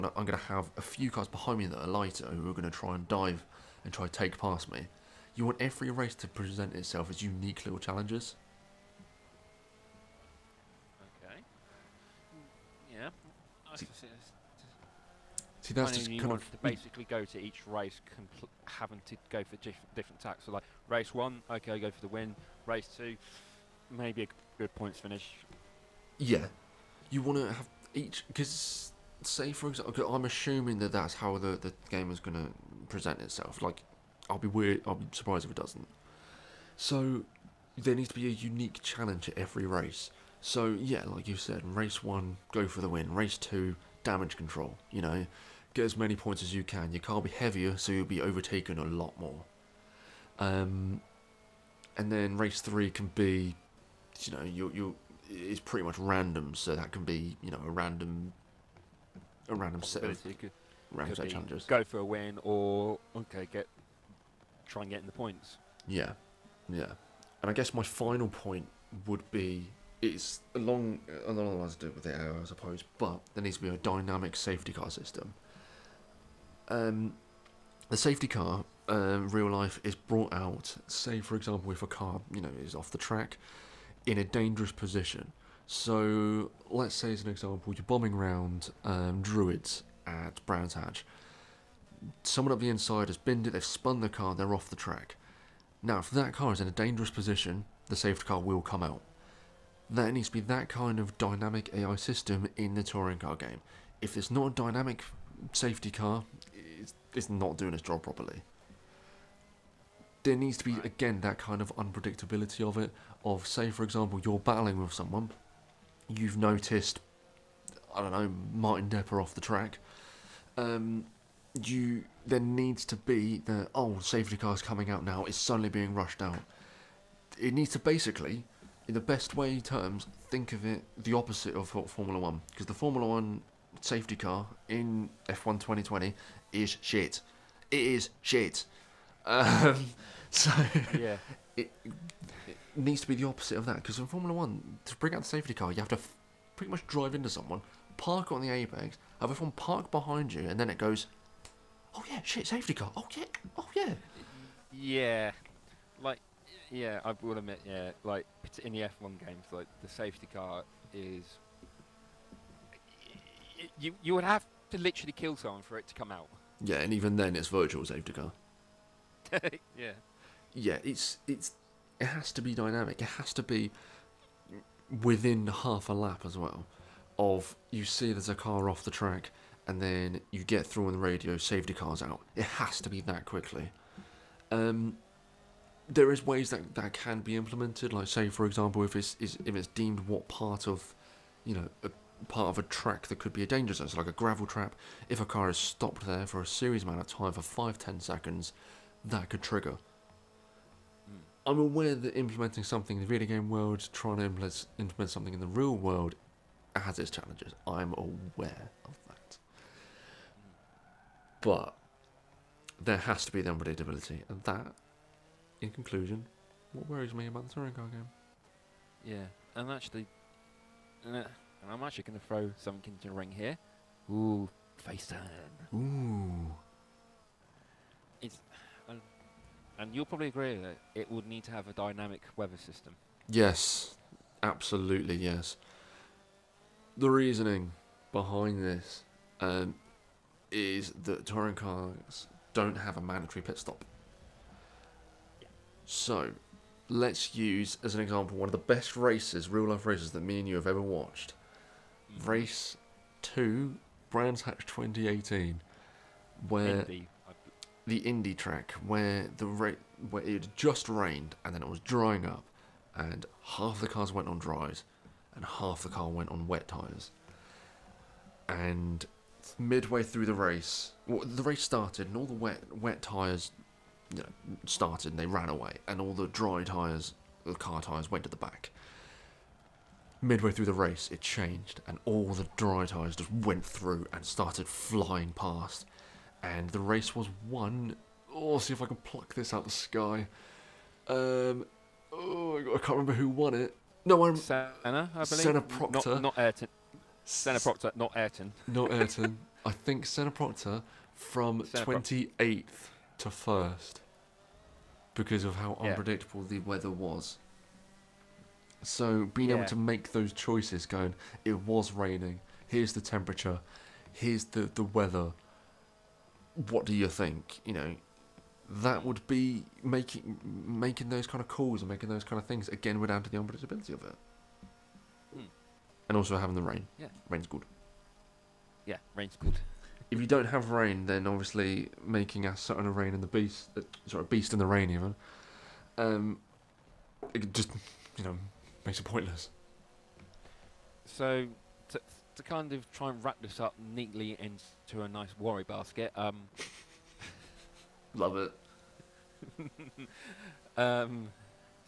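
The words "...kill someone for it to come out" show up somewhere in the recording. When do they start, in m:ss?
2:45.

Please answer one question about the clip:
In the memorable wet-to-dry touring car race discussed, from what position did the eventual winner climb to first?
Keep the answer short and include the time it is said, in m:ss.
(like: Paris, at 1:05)
28th, at 5:01.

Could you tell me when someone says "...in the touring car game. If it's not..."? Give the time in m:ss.
1:42.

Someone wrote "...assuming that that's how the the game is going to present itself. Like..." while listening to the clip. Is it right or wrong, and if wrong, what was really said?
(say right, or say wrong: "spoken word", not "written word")
right.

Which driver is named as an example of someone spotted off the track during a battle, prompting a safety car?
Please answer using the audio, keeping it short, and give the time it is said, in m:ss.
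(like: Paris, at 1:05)
Martin Depper, at 1:58.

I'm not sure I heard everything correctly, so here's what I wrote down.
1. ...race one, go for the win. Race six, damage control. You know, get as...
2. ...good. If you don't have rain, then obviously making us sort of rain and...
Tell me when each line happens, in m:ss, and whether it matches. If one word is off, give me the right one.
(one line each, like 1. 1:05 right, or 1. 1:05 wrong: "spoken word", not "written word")
1. 0:41 wrong: "two", not "six"
2. 5:29 right.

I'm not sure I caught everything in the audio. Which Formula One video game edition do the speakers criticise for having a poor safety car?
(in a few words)
F1 2020.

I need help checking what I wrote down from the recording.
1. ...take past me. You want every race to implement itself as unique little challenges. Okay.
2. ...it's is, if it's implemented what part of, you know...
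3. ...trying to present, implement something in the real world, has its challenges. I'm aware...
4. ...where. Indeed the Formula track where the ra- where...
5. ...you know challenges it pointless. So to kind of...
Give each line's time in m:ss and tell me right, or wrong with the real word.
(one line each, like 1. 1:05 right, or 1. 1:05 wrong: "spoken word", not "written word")
1. 0:04 wrong: "present", not "implement"
2. 3:08 wrong: "deemed", not "implemented"
3. 3:23 wrong: "implement", not "present"
4. 4:16 wrong: "Indy", not "Formula"
5. 5:38 wrong: "makes", not "challenges".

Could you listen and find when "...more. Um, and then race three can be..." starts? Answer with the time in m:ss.
0:49.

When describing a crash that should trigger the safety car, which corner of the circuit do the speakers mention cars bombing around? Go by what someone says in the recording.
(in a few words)
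Druids.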